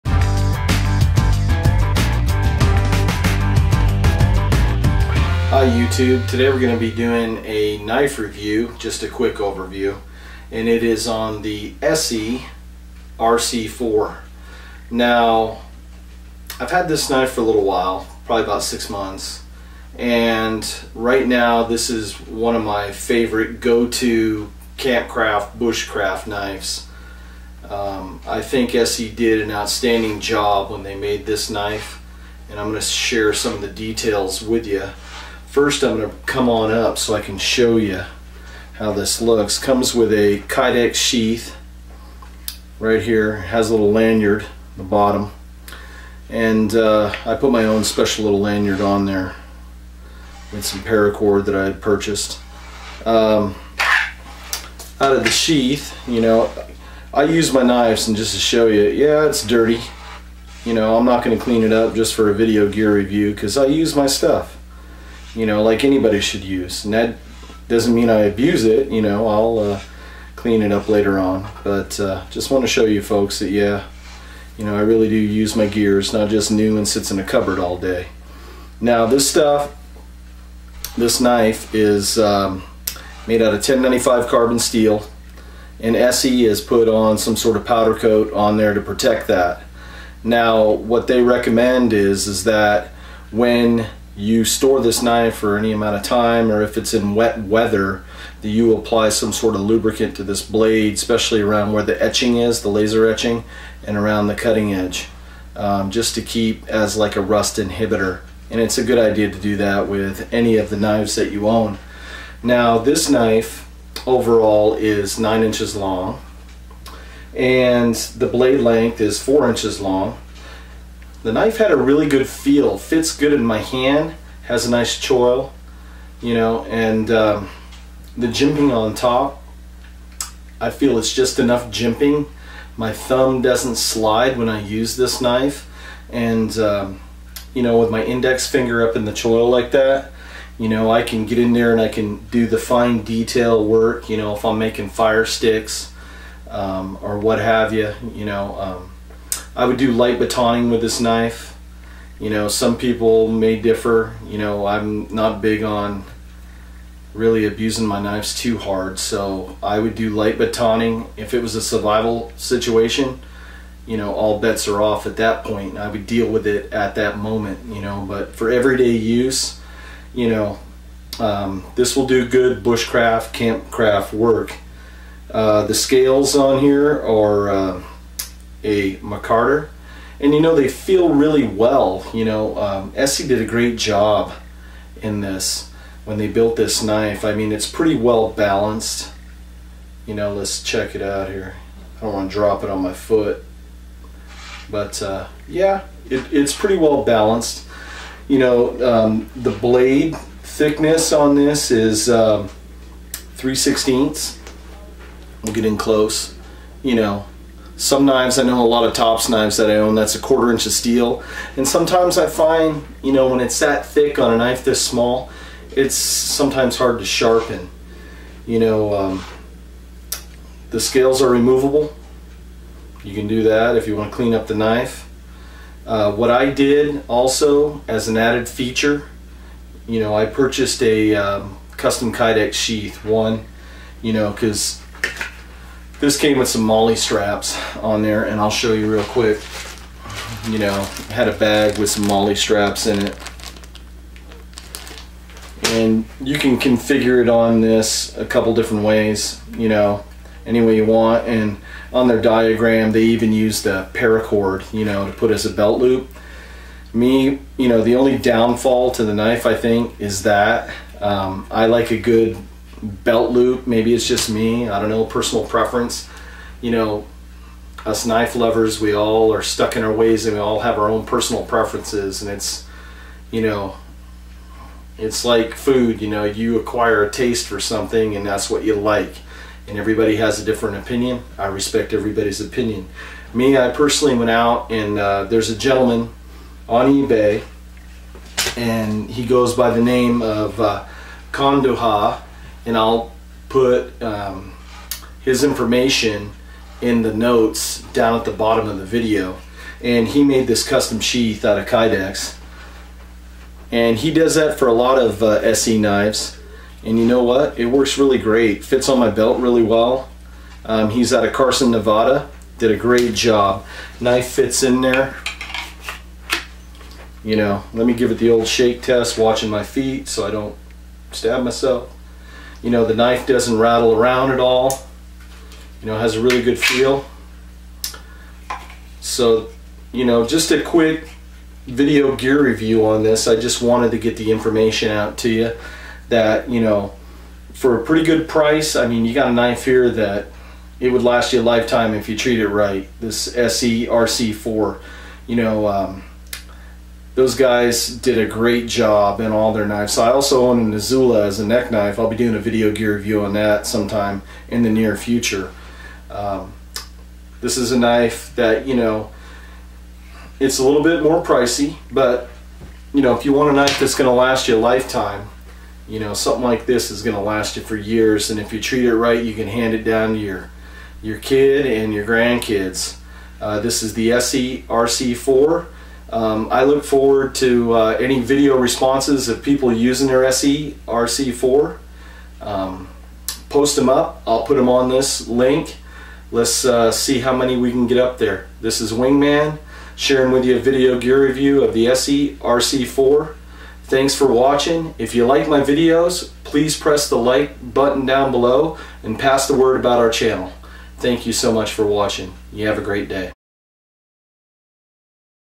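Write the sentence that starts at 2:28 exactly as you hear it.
Um, I would do light batoning with this knife.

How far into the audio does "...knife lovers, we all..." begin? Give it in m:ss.
4:28.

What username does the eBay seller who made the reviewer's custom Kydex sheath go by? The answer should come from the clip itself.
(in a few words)
Condahaw.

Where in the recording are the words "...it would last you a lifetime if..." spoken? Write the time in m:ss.
5:40.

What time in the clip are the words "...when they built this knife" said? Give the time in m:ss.
3:06.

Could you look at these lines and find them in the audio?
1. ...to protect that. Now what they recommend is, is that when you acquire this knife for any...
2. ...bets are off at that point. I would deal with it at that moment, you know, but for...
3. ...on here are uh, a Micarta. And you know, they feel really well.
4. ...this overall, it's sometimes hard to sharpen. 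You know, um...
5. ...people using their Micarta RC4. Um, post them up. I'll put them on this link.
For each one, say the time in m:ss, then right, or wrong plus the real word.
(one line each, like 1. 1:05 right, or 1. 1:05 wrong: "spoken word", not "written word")
1. 1:28 wrong: "store", not "acquire"
2. 2:44 right
3. 2:56 right
4. 3:34 wrong: "small", not "overall"
5. 6:19 wrong: "ESEE", not "Micarta".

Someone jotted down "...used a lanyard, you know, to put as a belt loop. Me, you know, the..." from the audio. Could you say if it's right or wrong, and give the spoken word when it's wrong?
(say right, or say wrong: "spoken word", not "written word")
wrong: "paracord", not "lanyard".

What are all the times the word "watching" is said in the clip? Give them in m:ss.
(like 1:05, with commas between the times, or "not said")
5:19, 6:34, 6:41.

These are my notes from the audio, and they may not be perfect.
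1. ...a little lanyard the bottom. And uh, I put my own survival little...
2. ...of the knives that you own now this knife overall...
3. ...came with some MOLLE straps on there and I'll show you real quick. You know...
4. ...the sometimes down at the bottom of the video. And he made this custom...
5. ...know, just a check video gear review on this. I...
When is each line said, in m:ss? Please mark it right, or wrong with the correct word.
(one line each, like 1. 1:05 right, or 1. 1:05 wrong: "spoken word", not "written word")
1. 0:43 wrong: "special", not "survival"
2. 1:50 right
3. 3:56 right
4. 4:57 wrong: "notes", not "sometimes"
5. 5:30 wrong: "quick", not "check".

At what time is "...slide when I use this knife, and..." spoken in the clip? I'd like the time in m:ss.
2:13.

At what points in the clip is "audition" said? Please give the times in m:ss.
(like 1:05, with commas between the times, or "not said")
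not said.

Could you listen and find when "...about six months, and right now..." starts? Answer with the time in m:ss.
0:18.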